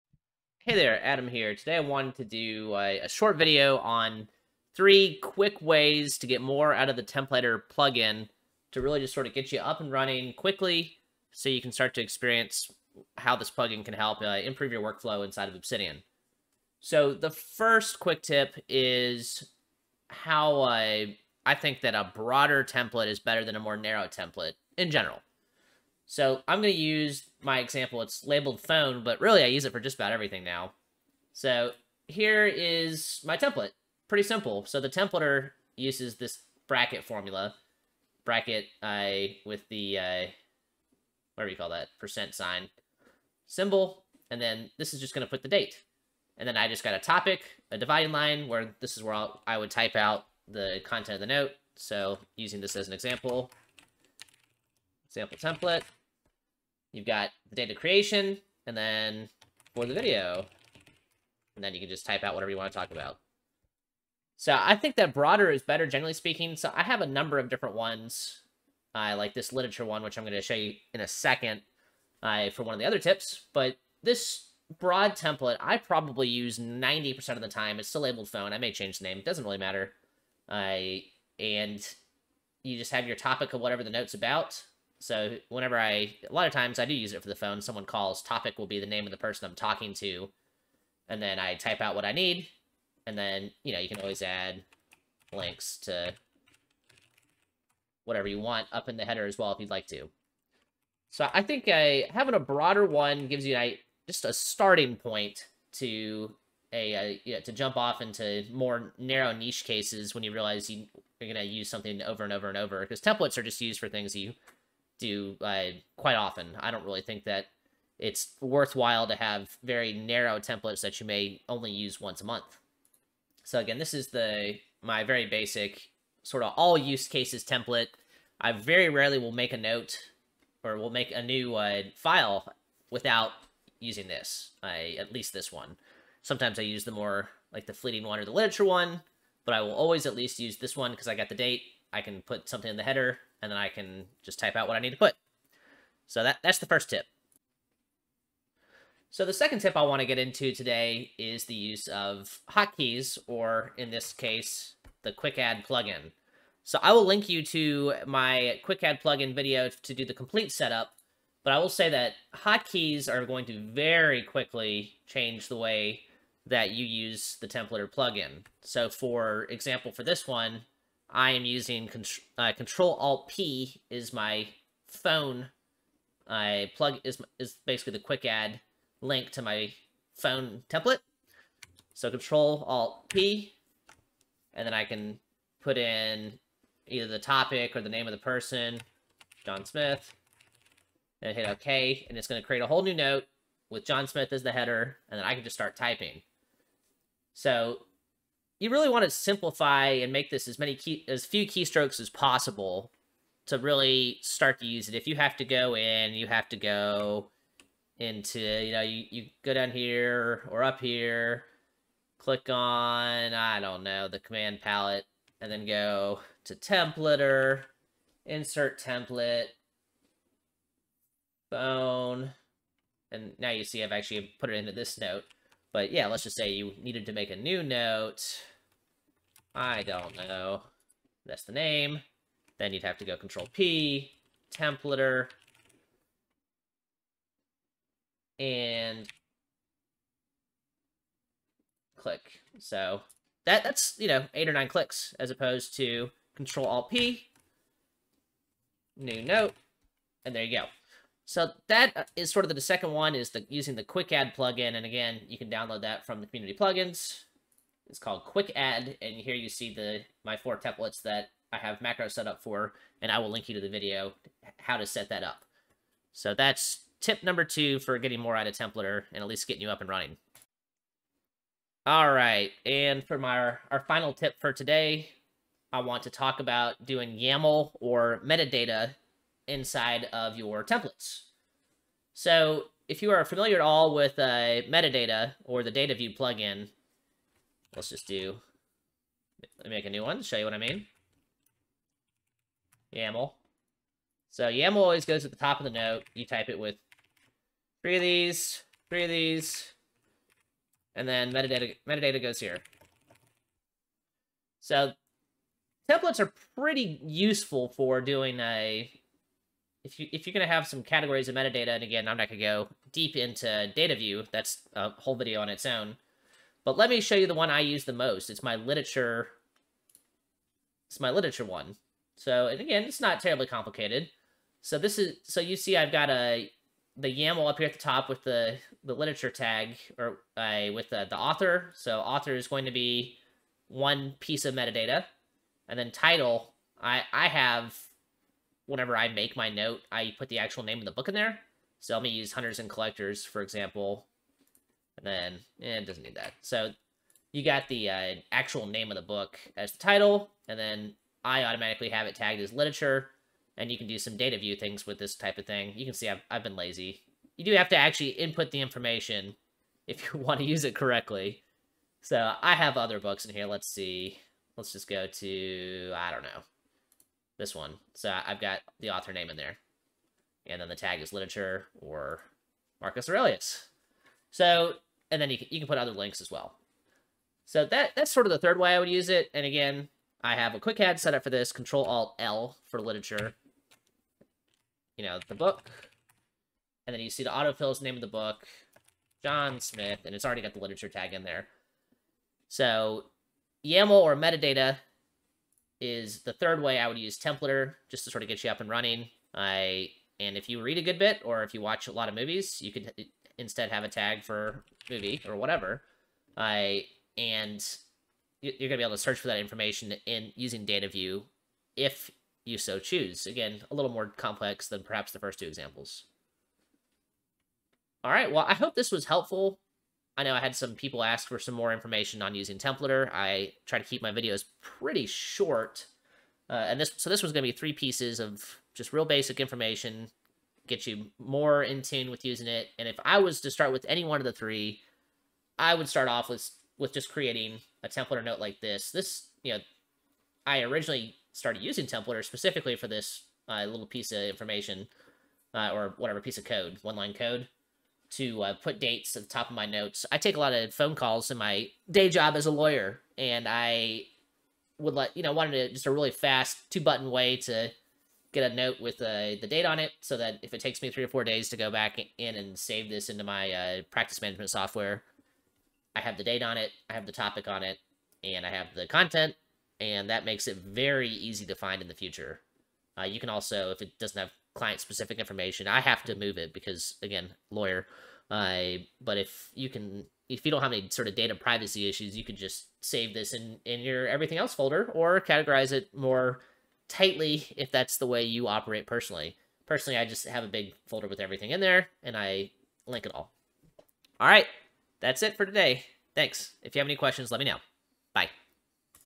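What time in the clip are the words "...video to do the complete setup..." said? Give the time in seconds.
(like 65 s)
159 s.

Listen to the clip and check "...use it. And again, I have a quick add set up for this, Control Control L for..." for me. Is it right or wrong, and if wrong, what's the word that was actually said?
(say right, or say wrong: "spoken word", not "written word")
wrong: "Alt", not "Control".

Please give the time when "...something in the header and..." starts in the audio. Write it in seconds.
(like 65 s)
142 s.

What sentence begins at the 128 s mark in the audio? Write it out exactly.
I very rarely will make a note or will make a new uh, file without using this, I, at least this one.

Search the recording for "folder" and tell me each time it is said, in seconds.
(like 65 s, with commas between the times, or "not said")
484 s, 490 s.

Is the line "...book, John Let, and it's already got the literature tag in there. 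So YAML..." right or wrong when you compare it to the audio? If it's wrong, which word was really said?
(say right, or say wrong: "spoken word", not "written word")
wrong: "Smith", not "Let".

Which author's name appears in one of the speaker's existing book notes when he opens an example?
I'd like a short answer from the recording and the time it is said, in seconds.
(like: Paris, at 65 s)
Marcus Aurelius, at 372 s.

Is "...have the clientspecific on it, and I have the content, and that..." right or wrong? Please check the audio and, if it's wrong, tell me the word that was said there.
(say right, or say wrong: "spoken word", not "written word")
wrong: "topic", not "clientspecific".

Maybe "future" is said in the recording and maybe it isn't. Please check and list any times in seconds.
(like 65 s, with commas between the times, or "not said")
471 s.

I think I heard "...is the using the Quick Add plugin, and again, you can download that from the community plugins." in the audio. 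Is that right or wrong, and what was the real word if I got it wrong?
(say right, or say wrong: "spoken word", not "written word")
right.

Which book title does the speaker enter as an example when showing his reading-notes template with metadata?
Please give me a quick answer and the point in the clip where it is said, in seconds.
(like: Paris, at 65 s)
Hunters and Collectors, at 342 s.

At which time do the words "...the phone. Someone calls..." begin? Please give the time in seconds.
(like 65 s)
87 s.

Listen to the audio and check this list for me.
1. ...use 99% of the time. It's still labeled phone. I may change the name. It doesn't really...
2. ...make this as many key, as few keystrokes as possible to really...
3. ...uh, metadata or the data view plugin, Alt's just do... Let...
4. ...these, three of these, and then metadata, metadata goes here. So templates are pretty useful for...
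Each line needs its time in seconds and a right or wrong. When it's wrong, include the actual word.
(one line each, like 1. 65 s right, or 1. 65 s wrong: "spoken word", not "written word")
1. 76 s wrong: "90", not "99"
2. 200 s right
3. 284 s wrong: "Let", not "Alt"
4. 298 s right.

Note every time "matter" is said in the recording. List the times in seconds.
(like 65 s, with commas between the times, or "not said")
79 s.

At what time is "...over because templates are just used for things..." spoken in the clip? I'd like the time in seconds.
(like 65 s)
112 s.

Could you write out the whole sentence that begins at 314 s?
That's a whole video on its own.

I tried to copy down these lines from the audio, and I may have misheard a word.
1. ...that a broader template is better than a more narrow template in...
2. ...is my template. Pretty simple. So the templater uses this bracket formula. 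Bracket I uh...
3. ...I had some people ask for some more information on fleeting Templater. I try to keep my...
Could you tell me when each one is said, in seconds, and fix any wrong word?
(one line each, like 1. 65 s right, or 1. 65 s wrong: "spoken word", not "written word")
1. 21 s right
2. 32 s right
3. 420 s wrong: "using", not "fleeting".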